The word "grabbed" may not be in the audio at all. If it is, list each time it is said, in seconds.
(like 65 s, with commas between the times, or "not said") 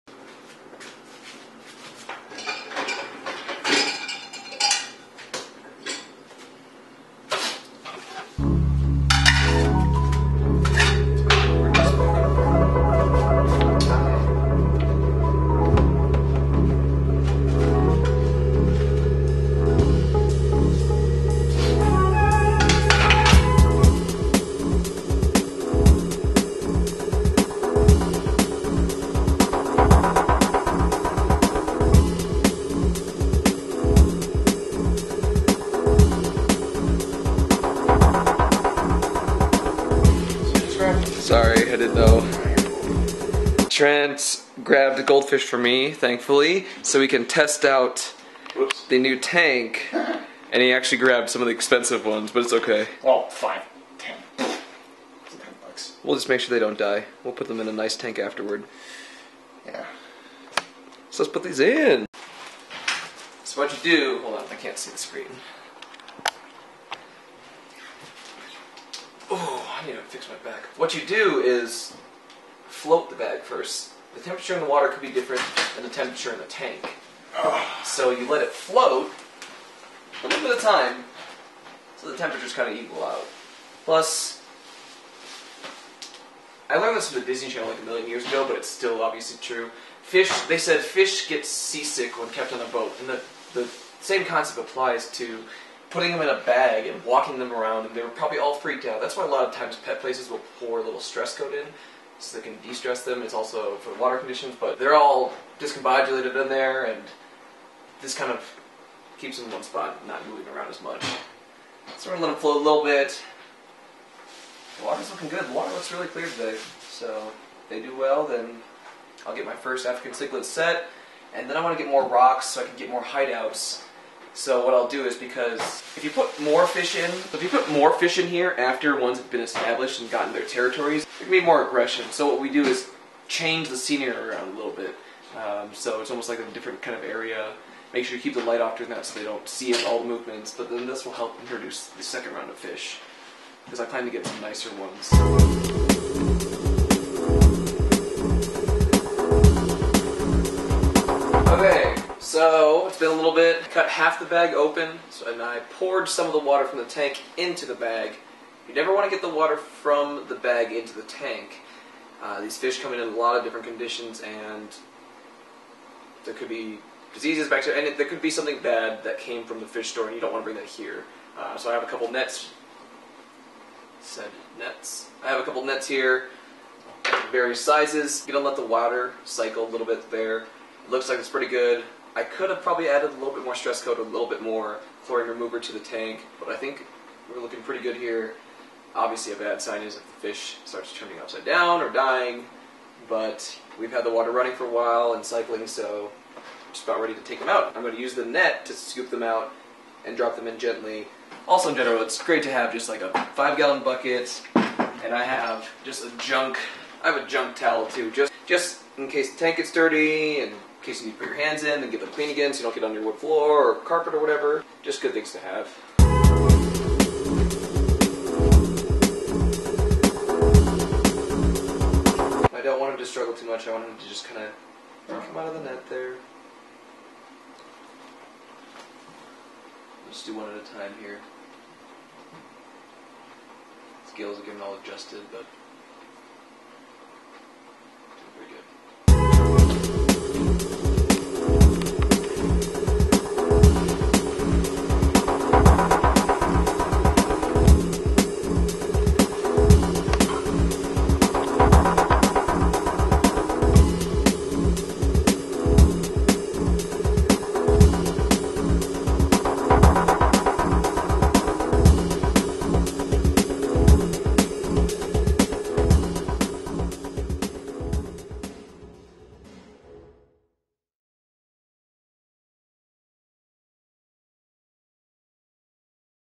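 44 s, 50 s.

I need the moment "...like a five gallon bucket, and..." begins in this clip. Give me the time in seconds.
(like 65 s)
202 s.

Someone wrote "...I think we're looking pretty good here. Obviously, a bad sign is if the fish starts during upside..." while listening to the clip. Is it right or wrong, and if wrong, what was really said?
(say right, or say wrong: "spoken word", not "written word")
wrong: "turning", not "during".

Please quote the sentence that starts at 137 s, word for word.
Make sure you keep the light off during that so they don't see it, all the movements.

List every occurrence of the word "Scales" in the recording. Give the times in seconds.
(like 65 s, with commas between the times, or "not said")
234 s.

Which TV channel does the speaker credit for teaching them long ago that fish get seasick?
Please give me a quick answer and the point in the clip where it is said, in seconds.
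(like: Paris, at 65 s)
Disney Channel, at 87 s.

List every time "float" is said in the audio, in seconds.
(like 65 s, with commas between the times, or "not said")
72 s, 78 s, 112 s.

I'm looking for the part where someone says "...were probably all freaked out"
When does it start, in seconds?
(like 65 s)
98 s.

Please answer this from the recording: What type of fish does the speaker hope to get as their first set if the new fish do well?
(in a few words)
African cichlid.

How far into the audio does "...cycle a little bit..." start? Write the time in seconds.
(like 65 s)
179 s.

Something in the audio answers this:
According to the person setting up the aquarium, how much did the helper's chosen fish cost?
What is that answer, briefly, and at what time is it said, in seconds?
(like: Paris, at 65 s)
10 bucks, at 54 s.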